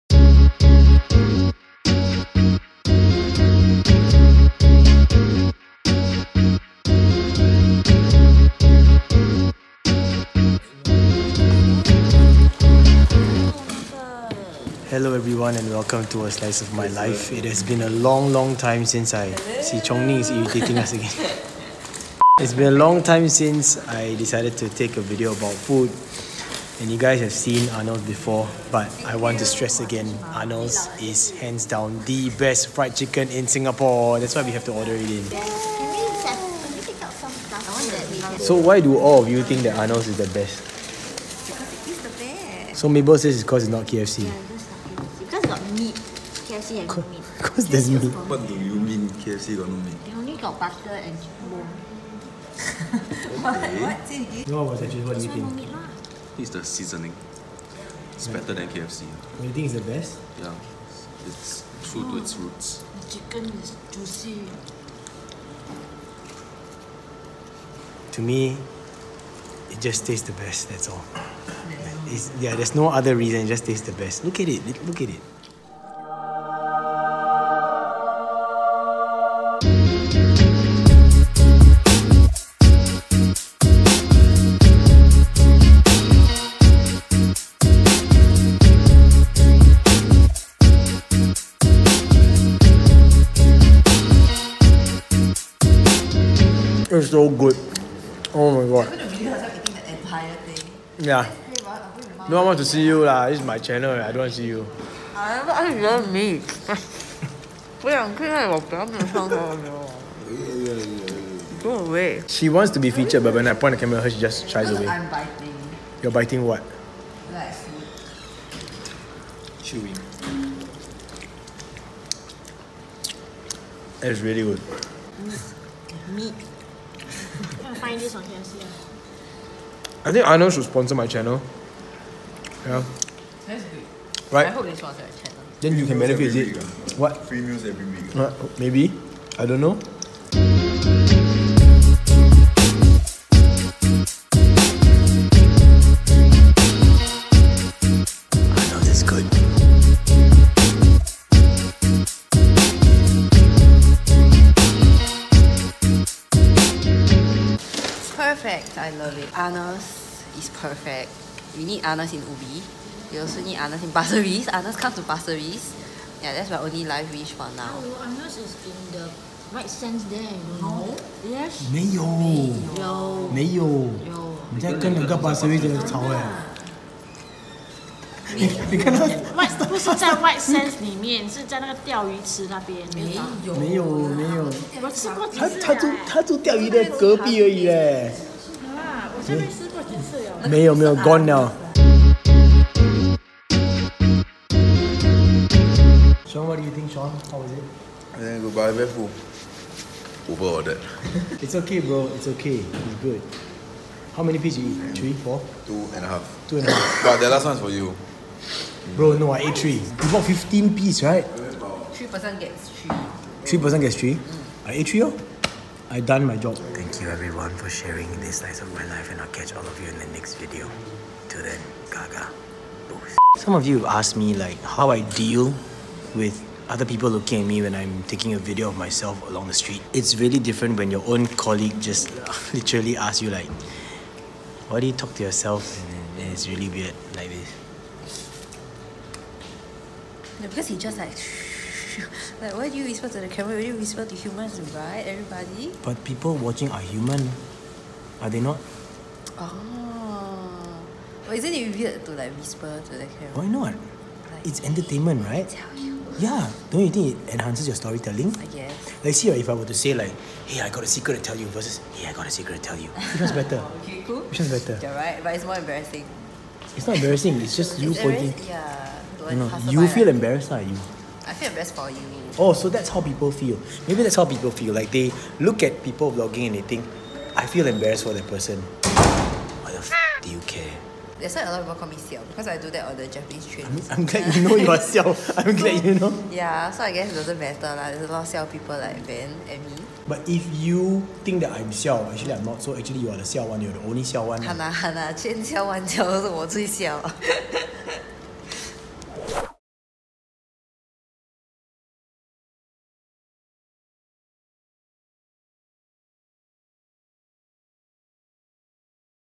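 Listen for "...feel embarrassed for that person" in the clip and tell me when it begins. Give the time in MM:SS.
04:37.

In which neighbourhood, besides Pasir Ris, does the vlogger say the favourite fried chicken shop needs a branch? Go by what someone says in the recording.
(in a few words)
Ubi.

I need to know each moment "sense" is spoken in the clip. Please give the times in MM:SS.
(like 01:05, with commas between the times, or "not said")
02:49, 03:00.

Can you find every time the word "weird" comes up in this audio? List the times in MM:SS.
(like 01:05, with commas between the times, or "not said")
03:56, 04:11.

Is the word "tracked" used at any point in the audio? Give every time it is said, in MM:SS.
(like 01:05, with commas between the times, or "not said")
not said.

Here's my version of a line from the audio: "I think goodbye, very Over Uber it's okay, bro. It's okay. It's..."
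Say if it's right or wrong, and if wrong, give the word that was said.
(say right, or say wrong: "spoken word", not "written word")
right.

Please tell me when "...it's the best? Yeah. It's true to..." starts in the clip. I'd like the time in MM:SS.
00:59.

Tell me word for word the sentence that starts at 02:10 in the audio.
I think Arnold should sponsor my channel.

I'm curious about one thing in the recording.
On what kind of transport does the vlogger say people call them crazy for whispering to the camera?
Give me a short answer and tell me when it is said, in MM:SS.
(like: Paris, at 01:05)
Japanese trains, at 04:43.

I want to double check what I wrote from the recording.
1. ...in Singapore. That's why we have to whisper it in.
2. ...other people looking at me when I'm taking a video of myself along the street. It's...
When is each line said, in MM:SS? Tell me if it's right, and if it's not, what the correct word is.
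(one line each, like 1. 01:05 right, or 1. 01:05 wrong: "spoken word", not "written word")
1. 00:33 wrong: "order", not "whisper"
2. 03:46 right.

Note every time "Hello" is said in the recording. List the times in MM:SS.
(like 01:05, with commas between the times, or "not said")
00:14, 02:47.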